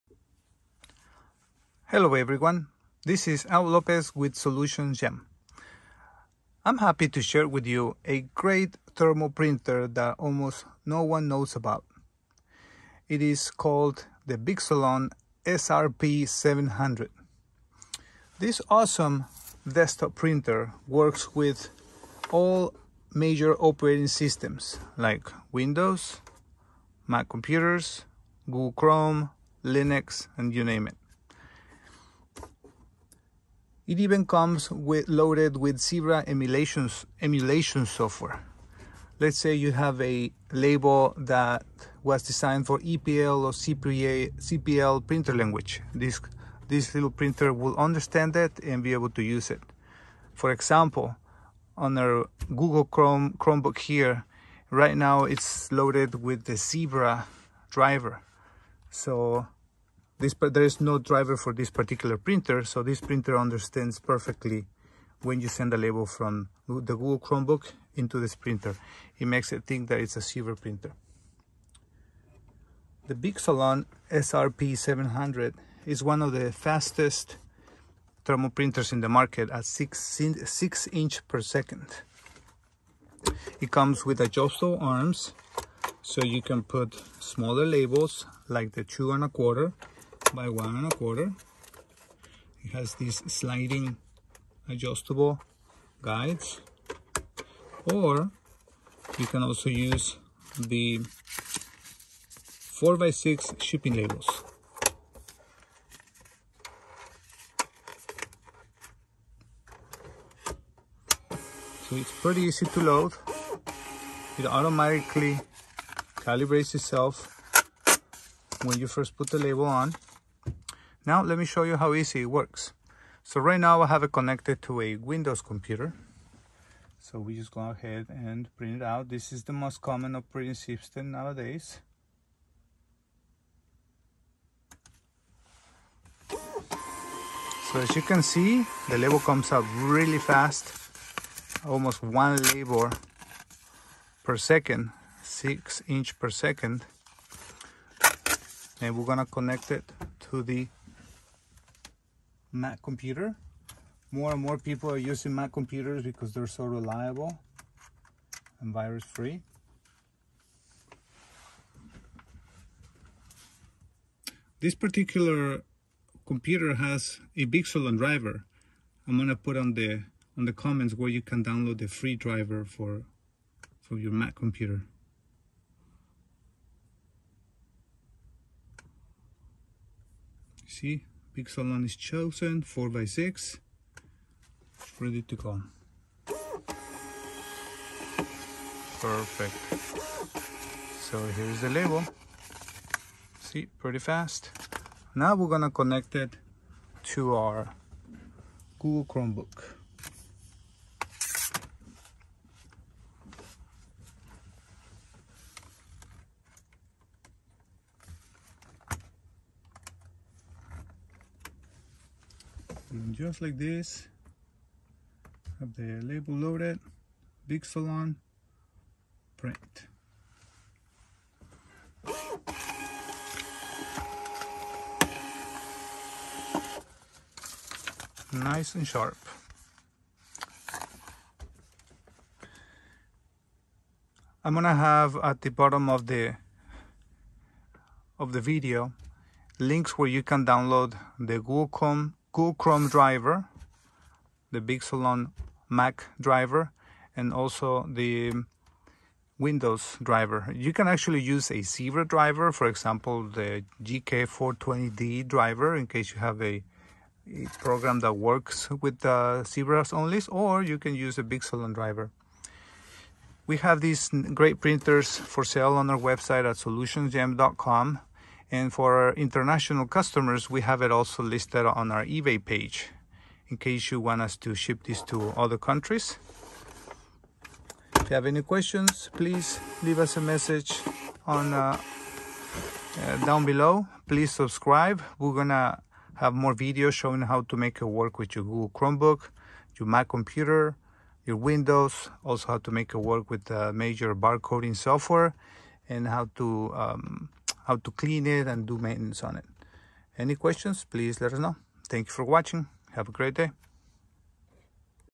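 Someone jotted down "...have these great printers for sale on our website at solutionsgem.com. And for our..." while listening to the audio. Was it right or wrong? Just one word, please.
right.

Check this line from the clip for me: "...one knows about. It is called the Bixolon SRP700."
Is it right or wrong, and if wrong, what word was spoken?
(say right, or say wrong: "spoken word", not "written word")
right.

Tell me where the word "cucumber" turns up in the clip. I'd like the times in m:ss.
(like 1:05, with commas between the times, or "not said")
not said.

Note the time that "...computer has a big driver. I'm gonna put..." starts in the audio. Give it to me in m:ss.
2:46.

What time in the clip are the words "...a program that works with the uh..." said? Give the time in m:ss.
4:17.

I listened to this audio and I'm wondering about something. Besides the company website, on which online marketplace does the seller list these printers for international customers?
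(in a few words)
eBay.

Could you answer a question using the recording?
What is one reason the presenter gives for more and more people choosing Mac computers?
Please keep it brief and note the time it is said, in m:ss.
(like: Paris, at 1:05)
Virus free, at 2:38.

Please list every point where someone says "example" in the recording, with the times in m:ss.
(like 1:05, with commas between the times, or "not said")
0:50, 4:12.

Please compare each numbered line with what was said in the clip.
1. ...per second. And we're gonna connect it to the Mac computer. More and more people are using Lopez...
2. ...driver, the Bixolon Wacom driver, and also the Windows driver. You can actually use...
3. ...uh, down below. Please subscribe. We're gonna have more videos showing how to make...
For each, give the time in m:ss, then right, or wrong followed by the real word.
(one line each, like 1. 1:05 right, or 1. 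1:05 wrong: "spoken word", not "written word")
1. 2:26 wrong: "Mac", not "Lopez"
2. 4:02 wrong: "Mac", not "Wacom"
3. 4:42 right.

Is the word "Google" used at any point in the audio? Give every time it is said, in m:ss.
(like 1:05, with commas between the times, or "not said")
0:28, 0:52, 1:06, 3:18, 4:02, 4:48.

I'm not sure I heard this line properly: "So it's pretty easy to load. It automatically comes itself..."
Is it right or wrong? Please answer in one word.
wrong.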